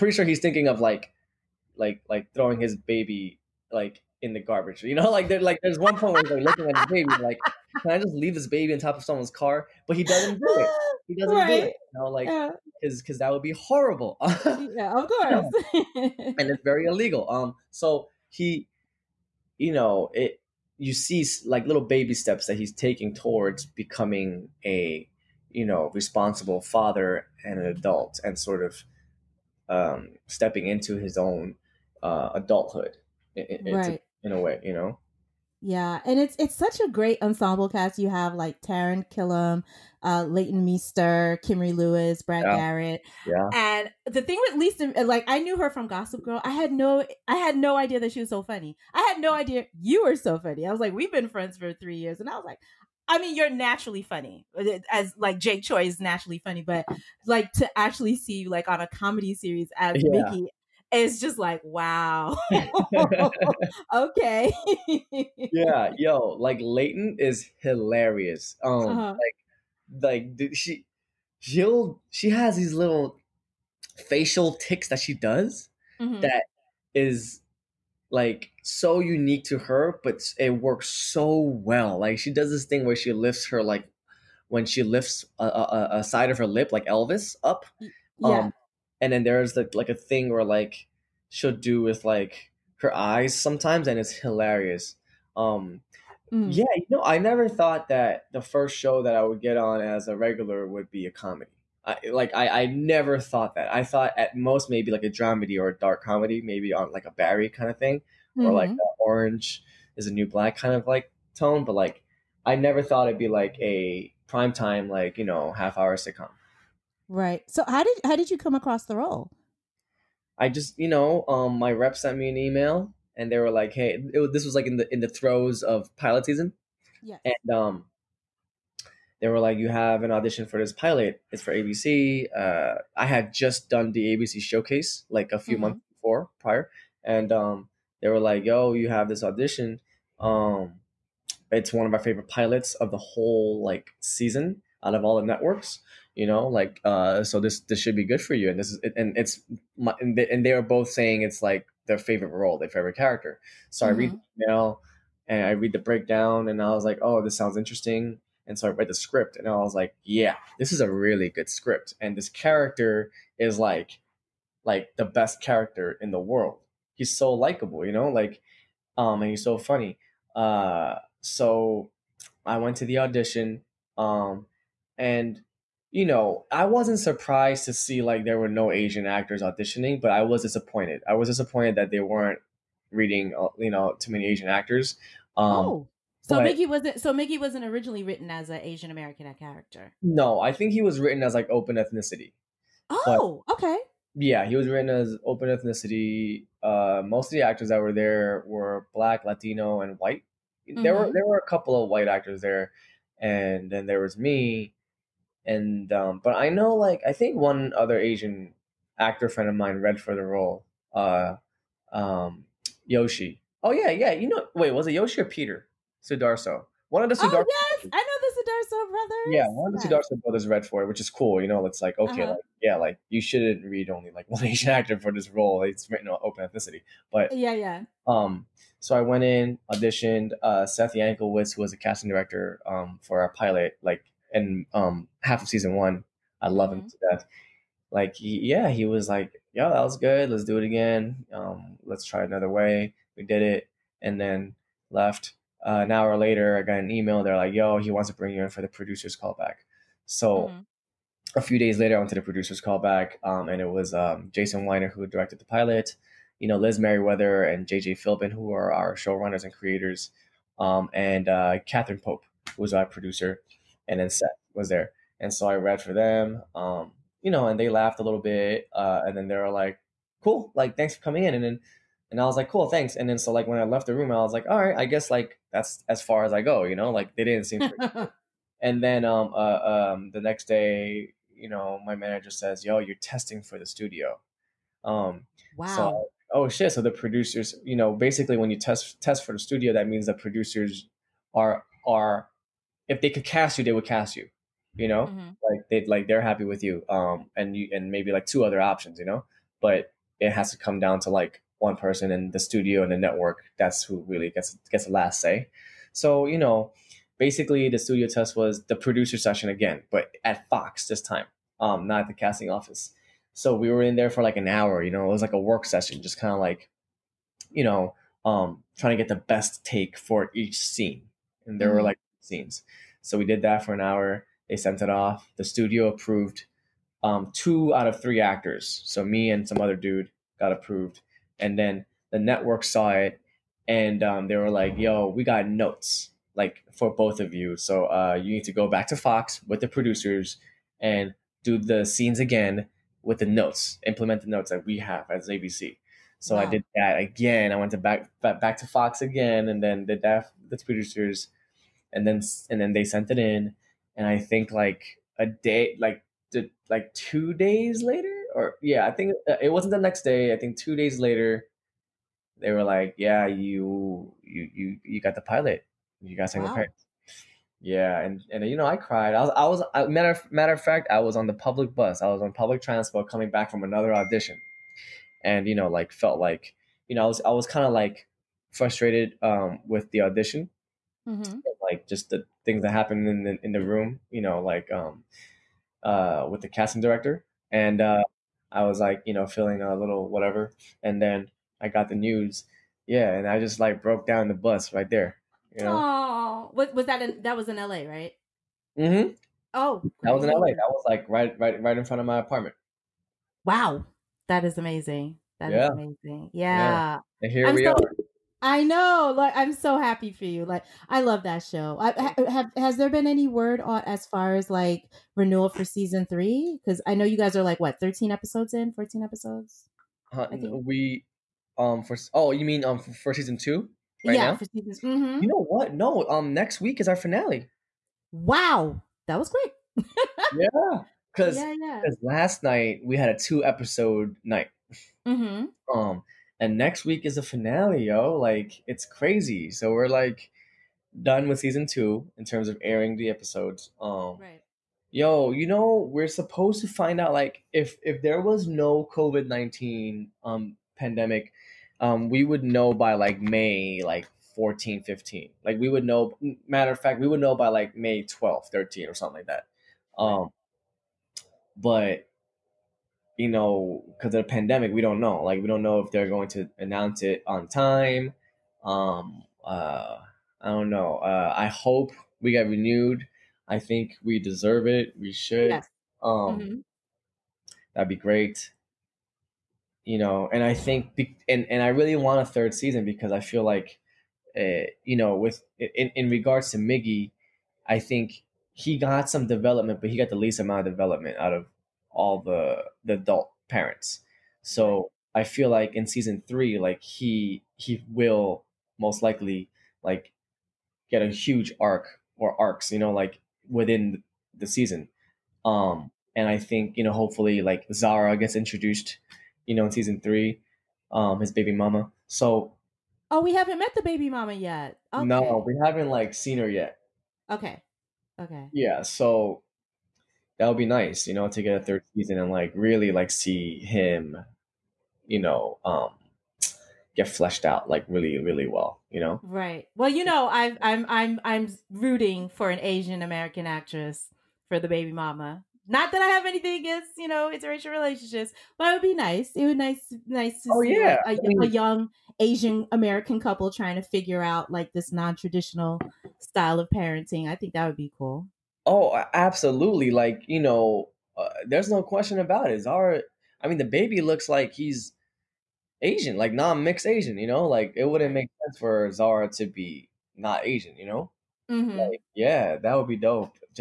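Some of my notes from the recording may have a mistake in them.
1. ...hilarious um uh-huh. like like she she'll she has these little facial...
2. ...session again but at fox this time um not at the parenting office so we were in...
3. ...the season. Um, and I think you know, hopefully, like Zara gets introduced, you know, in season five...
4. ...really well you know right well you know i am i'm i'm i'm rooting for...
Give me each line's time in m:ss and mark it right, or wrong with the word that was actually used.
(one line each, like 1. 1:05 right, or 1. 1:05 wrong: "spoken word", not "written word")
1. 1:07 right
2. 5:09 wrong: "casting", not "parenting"
3. 8:24 wrong: "three", not "five"
4. 8:48 right.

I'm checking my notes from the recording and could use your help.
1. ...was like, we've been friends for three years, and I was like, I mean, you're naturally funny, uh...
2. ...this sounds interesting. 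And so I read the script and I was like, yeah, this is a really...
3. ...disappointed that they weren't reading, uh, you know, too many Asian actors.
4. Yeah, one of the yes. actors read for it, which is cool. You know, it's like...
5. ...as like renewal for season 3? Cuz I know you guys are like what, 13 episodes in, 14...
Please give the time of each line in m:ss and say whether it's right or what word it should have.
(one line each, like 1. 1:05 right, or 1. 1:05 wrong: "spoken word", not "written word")
1. 0:50 right
2. 2:37 right
3. 3:01 right
4. 3:39 wrong: "brothers", not "actors"
5. 6:54 right.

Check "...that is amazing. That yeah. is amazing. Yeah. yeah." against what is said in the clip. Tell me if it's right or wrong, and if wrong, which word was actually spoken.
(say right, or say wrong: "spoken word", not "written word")
right.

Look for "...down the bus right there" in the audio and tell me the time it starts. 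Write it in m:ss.
6:34.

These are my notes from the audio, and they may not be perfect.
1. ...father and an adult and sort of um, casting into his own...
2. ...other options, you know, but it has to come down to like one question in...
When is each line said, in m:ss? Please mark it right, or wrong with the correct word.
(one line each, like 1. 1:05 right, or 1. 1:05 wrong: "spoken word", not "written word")
1. 0:26 wrong: "stepping", not "casting"
2. 4:58 wrong: "person", not "question".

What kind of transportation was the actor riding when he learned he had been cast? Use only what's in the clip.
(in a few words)
public bus.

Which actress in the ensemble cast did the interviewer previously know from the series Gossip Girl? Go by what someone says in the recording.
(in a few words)
Leighton Meester.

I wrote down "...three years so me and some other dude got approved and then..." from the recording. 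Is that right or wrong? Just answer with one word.
wrong.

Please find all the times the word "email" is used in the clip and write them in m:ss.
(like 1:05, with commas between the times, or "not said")
2:02, 2:34, 4:06.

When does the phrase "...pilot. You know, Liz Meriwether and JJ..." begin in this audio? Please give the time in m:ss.
4:15.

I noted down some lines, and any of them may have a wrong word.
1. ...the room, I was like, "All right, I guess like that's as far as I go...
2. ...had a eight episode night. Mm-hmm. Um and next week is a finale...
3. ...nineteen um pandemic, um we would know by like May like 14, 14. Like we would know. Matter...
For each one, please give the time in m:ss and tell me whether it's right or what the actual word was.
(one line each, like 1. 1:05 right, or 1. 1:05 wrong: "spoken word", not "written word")
1. 4:33 right
2. 7:12 wrong: "two", not "eight"
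3. 7:29 wrong: "15", not "14".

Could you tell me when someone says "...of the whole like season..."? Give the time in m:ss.
2:22.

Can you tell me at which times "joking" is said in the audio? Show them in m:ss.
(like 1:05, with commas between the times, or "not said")
not said.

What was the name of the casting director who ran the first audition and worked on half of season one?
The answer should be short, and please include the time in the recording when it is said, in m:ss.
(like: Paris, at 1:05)
Seth Yanklewitz, at 3:50.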